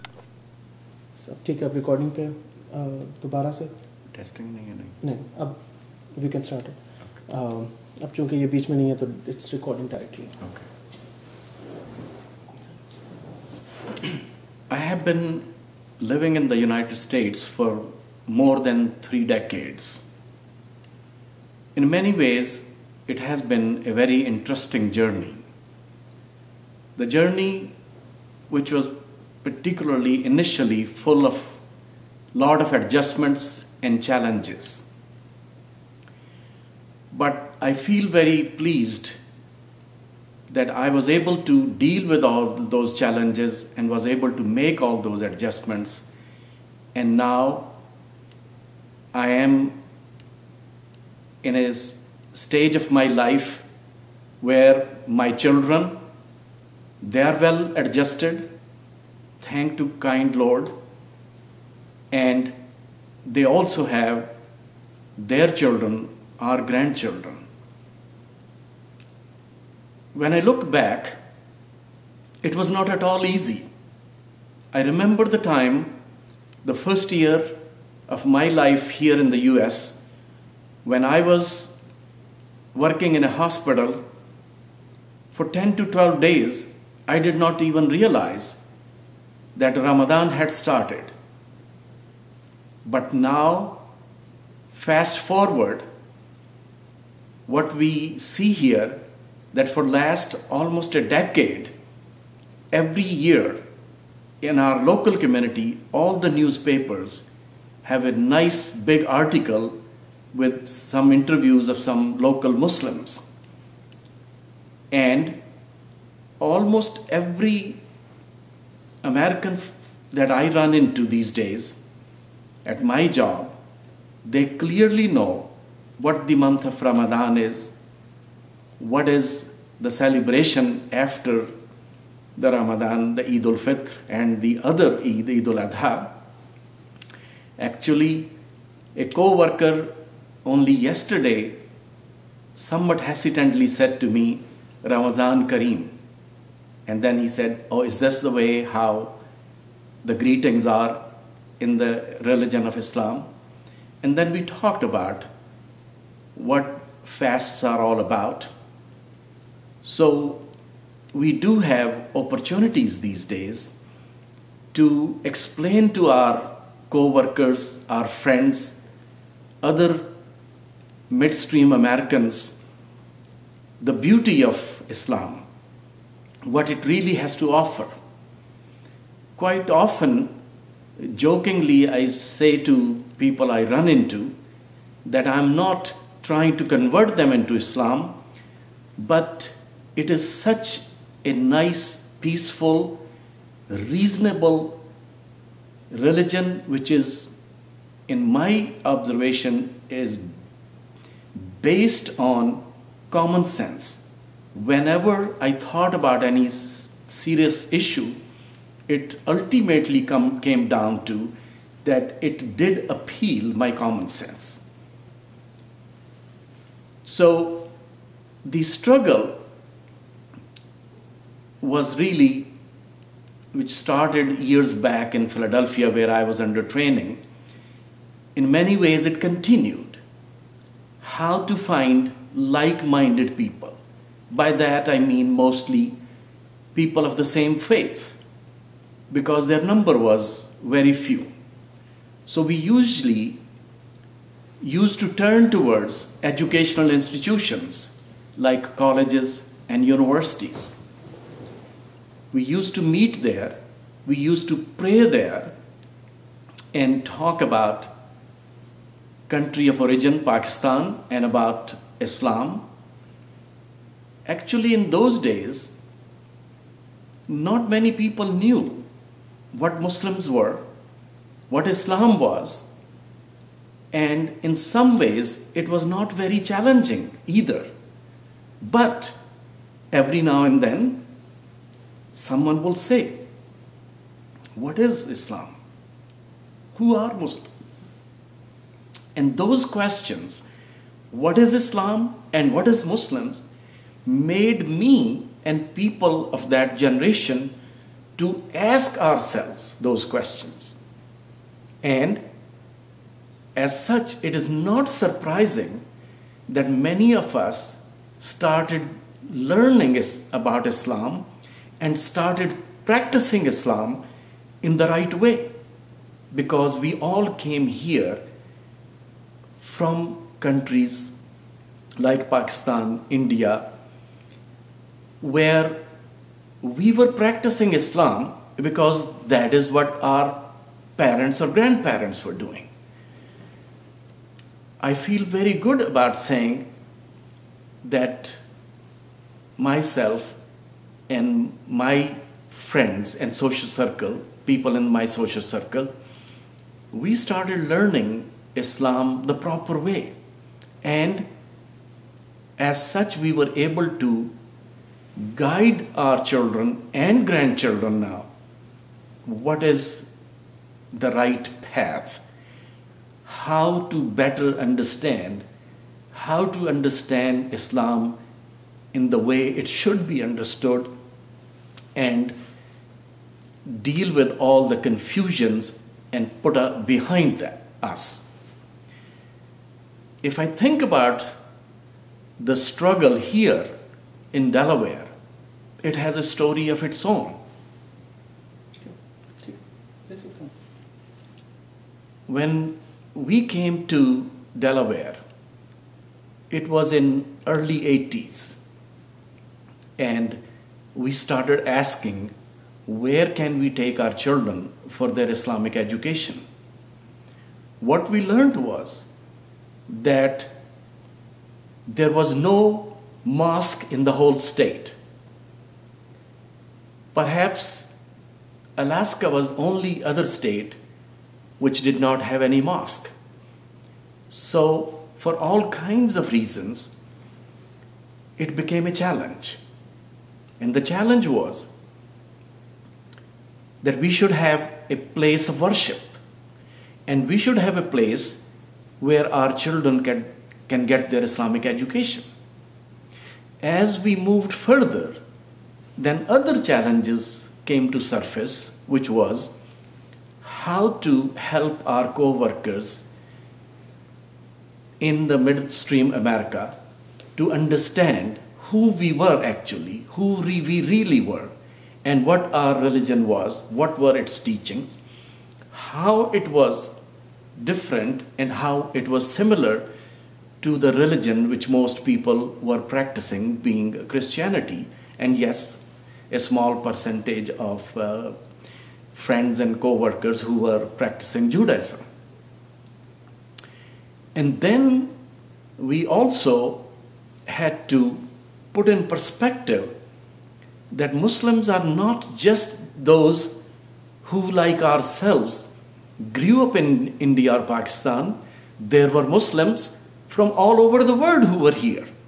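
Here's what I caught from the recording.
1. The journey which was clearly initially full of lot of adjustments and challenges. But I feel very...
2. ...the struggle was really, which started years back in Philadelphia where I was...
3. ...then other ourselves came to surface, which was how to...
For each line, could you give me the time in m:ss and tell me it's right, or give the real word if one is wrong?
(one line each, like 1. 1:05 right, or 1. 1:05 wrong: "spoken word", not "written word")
1. 0:26 wrong: "particularly", not "clearly"
2. 3:38 right
3. 7:25 wrong: "challenges", not "ourselves".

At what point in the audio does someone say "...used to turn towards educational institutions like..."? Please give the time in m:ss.
4:04.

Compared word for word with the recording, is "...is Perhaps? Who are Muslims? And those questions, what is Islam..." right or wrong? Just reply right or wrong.
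wrong.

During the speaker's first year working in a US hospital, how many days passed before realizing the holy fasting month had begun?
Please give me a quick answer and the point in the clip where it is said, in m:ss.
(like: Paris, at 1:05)
10 to 12 days, at 1:25.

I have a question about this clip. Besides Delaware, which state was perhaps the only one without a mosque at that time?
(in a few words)
Alaska.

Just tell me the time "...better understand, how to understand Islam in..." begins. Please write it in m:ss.
6:04.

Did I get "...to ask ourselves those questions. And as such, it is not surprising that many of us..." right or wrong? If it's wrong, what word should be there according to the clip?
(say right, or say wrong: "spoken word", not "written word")
right.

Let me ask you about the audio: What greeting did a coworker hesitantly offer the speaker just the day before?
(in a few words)
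Ramazan Kareem.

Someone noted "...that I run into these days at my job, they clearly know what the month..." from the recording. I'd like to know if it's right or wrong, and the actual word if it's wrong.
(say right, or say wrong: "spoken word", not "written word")
right.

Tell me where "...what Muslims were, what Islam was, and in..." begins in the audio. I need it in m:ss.
4:29.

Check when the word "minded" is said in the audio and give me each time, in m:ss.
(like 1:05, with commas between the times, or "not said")
3:52.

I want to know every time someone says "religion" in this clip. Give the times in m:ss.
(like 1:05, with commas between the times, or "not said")
2:32, 3:15, 7:42, 7:50.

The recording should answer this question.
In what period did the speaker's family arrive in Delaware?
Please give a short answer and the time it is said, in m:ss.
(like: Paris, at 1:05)
Early 80s, at 6:37.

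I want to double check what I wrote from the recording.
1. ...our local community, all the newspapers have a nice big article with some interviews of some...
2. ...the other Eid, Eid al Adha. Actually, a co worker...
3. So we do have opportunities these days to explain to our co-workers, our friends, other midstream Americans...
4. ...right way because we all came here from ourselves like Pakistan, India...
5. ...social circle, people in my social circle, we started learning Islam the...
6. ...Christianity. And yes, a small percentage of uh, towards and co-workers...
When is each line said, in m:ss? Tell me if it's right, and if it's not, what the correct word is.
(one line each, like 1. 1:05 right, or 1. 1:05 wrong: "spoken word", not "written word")
1. 1:44 right
2. 2:14 right
3. 2:39 right
4. 5:14 wrong: "countries", not "ourselves"
5. 5:43 right
6. 7:54 wrong: "friends", not "towards".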